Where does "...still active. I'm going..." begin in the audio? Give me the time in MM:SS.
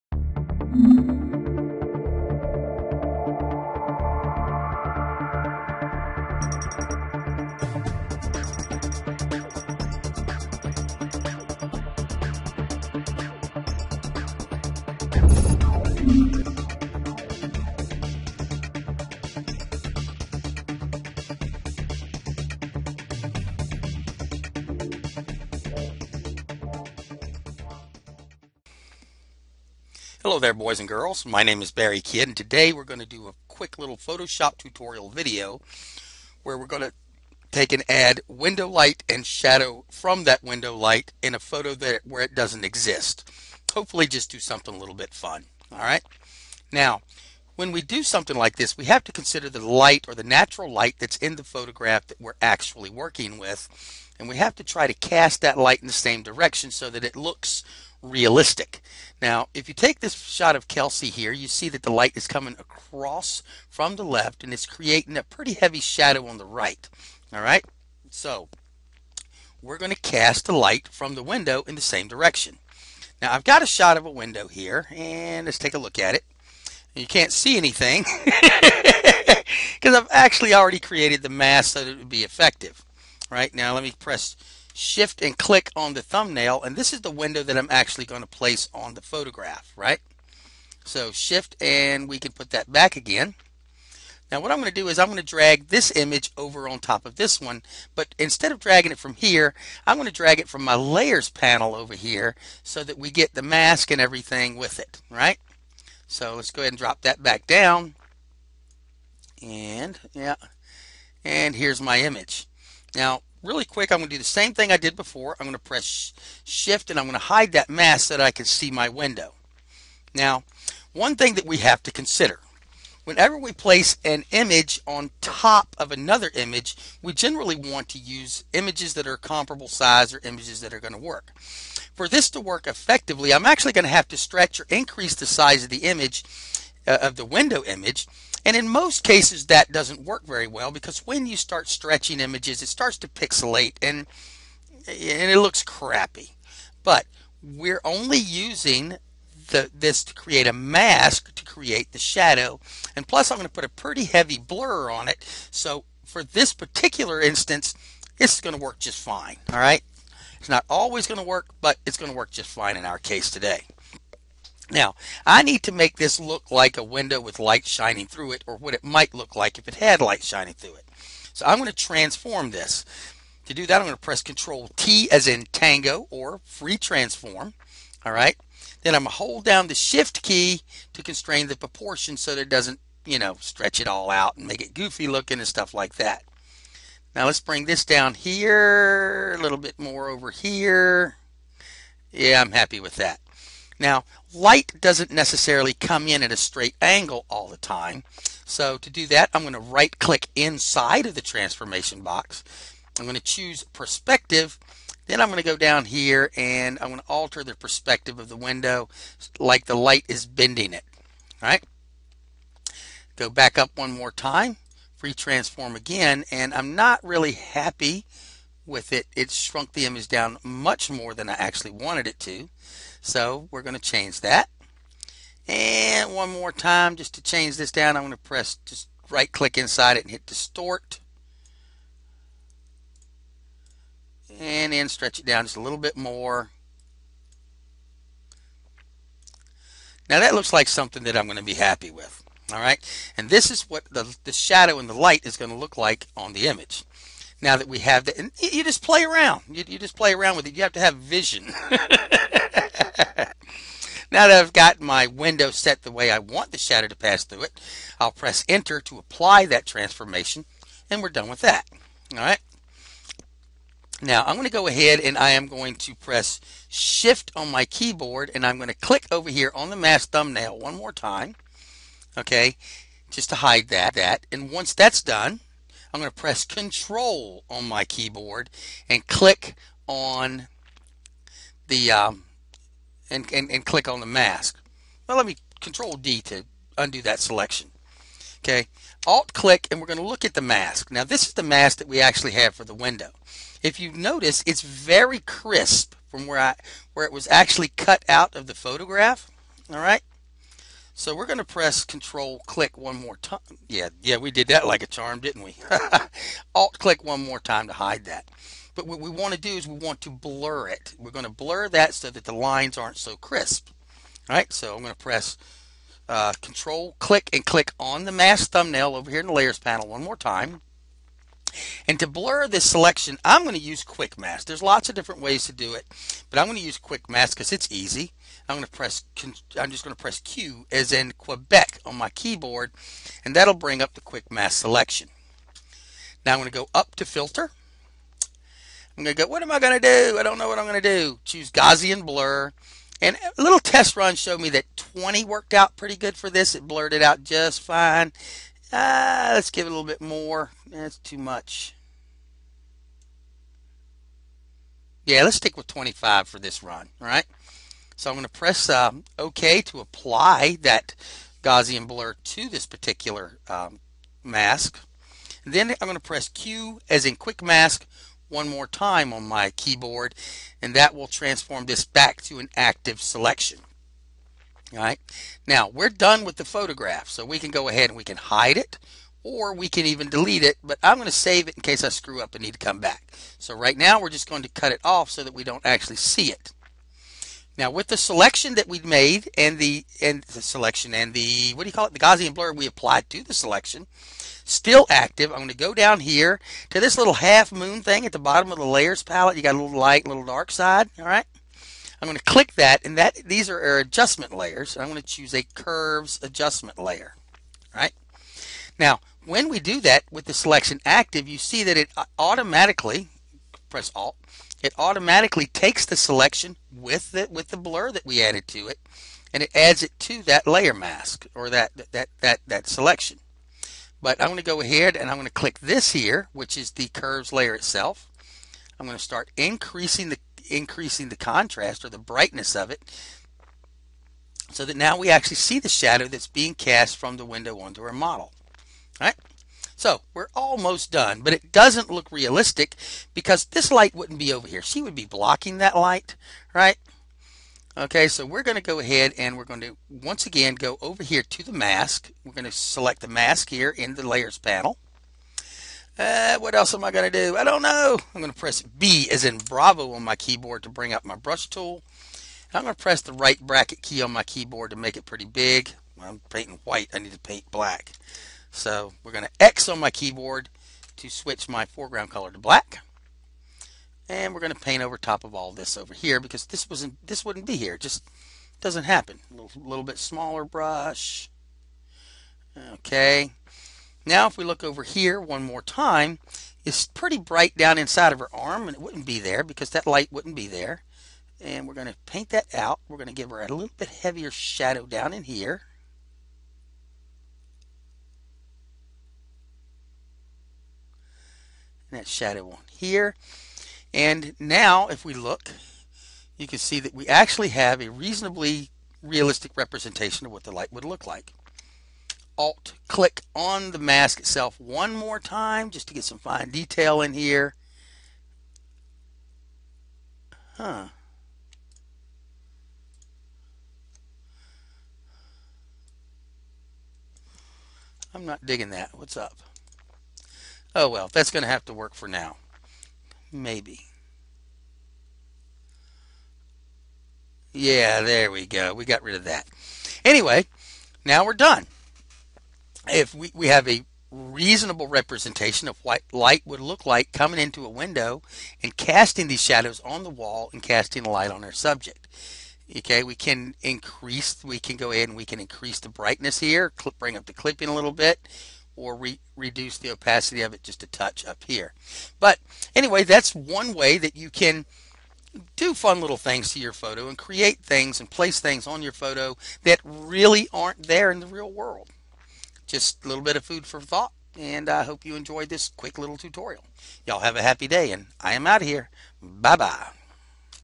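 06:34.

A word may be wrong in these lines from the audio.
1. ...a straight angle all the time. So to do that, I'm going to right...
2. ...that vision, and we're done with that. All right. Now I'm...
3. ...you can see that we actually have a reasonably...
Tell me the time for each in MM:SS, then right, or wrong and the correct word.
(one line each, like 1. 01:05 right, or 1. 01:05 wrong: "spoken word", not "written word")
1. 03:16 right
2. 04:19 wrong: "transformation", not "vision"
3. 08:26 right.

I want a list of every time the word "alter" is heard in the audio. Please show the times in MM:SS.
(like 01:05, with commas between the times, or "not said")
03:27.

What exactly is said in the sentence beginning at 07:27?
Okay, so we're going to go ahead and we're going to once again go over here to the mask.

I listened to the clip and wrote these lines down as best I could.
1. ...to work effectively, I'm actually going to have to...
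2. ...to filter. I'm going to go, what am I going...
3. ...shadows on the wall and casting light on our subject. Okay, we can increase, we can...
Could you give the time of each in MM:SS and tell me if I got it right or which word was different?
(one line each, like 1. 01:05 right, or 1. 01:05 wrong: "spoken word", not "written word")
1. 02:12 right
2. 05:36 right
3. 09:09 right.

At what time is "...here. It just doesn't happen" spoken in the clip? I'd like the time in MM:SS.
07:57.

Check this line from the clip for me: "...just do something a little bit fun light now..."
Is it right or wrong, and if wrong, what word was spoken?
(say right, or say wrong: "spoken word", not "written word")
wrong: "alright", not "light".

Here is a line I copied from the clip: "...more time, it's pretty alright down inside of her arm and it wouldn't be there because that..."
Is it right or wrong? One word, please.
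wrong.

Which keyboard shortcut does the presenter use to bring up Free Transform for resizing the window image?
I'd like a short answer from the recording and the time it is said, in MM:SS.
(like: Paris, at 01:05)
Control T, at 02:54.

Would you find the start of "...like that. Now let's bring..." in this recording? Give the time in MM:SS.
03:05.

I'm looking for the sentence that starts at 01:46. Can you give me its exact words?
So let's go ahead and drop that back down.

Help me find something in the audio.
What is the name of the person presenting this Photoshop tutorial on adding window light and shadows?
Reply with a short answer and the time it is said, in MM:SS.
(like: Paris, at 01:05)
Barry Kidd, at 00:31.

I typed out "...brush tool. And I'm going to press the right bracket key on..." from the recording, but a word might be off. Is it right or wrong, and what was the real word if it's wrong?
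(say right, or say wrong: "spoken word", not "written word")
right.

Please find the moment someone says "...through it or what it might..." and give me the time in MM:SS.
02:48.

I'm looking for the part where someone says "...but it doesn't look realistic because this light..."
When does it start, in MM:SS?
07:21.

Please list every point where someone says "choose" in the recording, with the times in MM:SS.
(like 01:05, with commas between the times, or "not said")
03:23, 05:41, 06:45.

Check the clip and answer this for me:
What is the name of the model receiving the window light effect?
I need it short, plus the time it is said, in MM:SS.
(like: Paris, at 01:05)
Kelsey, at 01:00.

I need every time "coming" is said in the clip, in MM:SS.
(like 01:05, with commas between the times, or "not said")
01:02, 09:07.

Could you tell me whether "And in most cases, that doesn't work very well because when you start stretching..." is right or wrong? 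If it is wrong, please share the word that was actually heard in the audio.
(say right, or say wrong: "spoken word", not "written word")
right.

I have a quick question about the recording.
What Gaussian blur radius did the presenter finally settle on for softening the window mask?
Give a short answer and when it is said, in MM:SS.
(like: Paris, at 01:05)
25, at 05:55.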